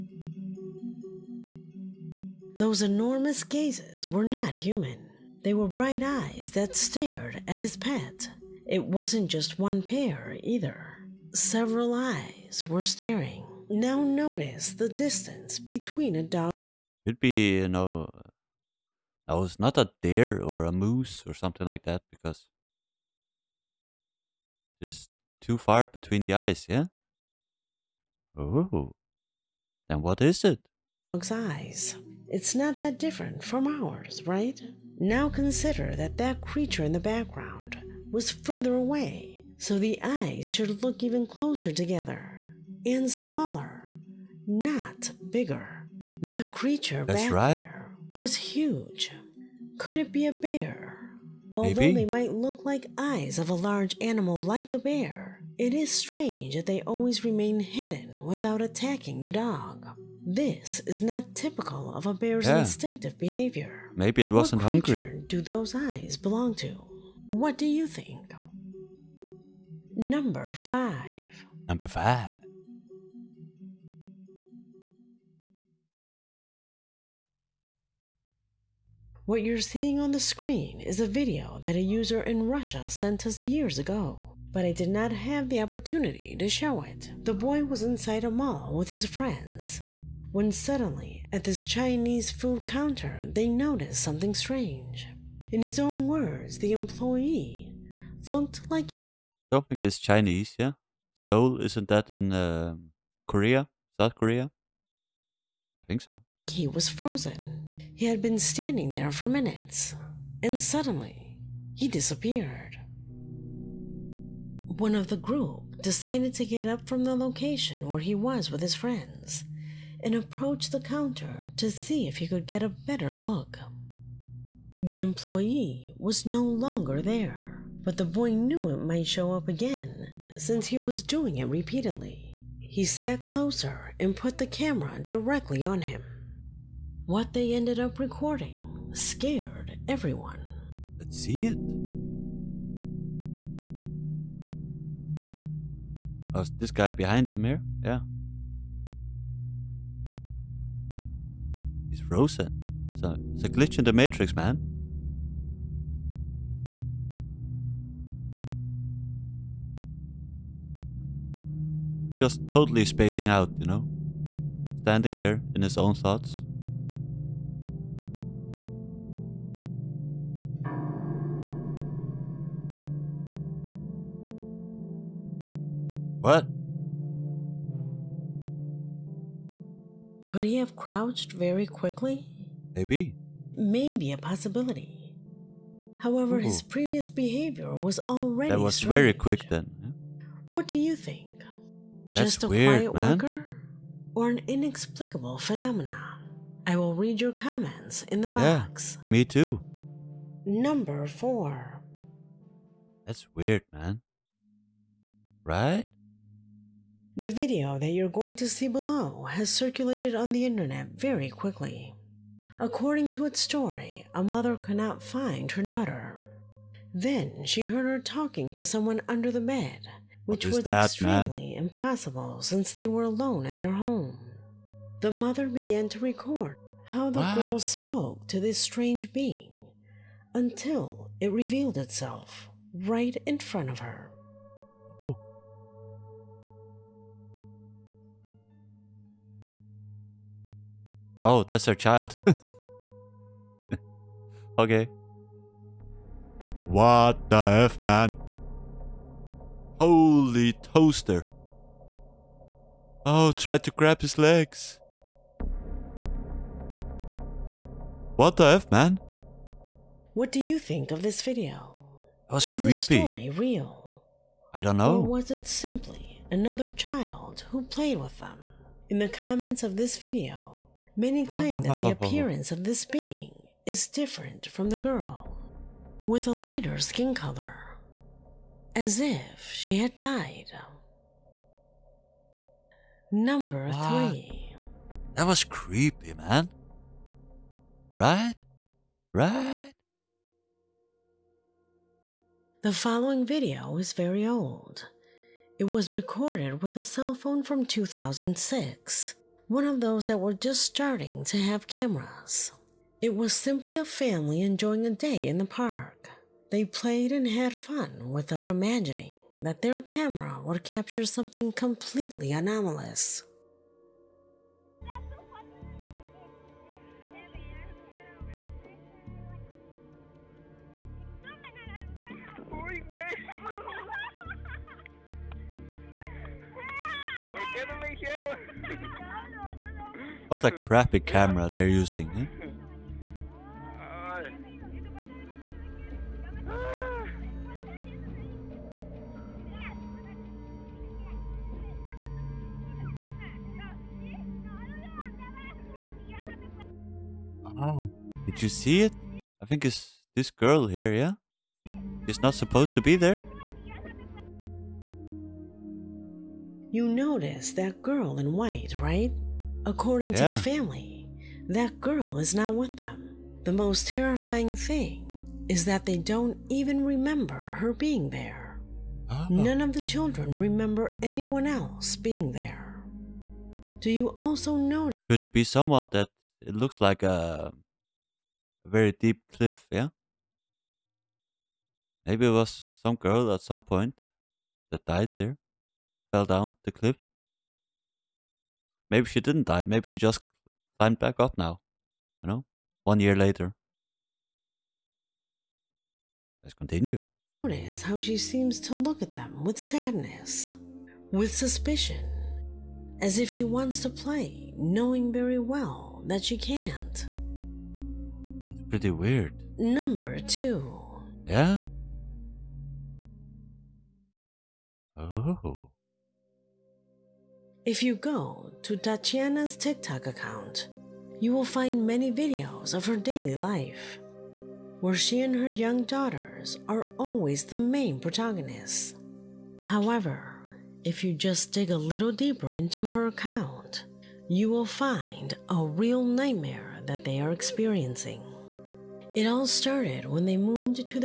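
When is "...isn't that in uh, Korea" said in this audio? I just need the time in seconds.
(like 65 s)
101 s.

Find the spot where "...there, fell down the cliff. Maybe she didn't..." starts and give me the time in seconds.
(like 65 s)
385 s.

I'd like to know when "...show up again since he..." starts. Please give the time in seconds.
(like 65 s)
129 s.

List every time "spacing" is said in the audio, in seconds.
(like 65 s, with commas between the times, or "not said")
162 s.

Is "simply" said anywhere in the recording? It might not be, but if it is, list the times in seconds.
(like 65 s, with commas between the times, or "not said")
265 s, 303 s.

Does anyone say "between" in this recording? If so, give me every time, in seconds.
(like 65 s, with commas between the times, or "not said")
15 s, 25 s.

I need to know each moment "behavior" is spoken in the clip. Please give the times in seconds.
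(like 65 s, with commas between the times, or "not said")
63 s, 187 s.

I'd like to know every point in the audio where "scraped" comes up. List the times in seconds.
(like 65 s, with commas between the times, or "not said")
not said.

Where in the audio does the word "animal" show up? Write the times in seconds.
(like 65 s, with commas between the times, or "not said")
54 s.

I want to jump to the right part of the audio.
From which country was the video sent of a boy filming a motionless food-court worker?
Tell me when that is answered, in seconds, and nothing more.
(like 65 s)
82 s.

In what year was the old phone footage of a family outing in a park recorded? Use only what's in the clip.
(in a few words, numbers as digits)
2006.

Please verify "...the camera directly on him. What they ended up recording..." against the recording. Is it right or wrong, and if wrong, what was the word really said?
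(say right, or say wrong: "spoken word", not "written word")
right.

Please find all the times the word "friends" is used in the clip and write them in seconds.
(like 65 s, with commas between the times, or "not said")
89 s, 118 s.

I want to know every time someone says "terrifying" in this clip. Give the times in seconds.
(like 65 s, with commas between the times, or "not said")
363 s.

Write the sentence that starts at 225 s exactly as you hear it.
The mother began to record how the what?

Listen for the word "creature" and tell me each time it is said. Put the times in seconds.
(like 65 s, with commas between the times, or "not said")
36 s, 46 s.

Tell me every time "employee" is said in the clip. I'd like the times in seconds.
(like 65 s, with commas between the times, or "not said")
96 s, 124 s.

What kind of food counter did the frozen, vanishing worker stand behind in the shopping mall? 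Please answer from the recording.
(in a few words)
Chinese food.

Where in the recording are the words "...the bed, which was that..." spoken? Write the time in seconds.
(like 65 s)
219 s.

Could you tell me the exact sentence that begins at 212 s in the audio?
According to its story, a mother could not find her daughter.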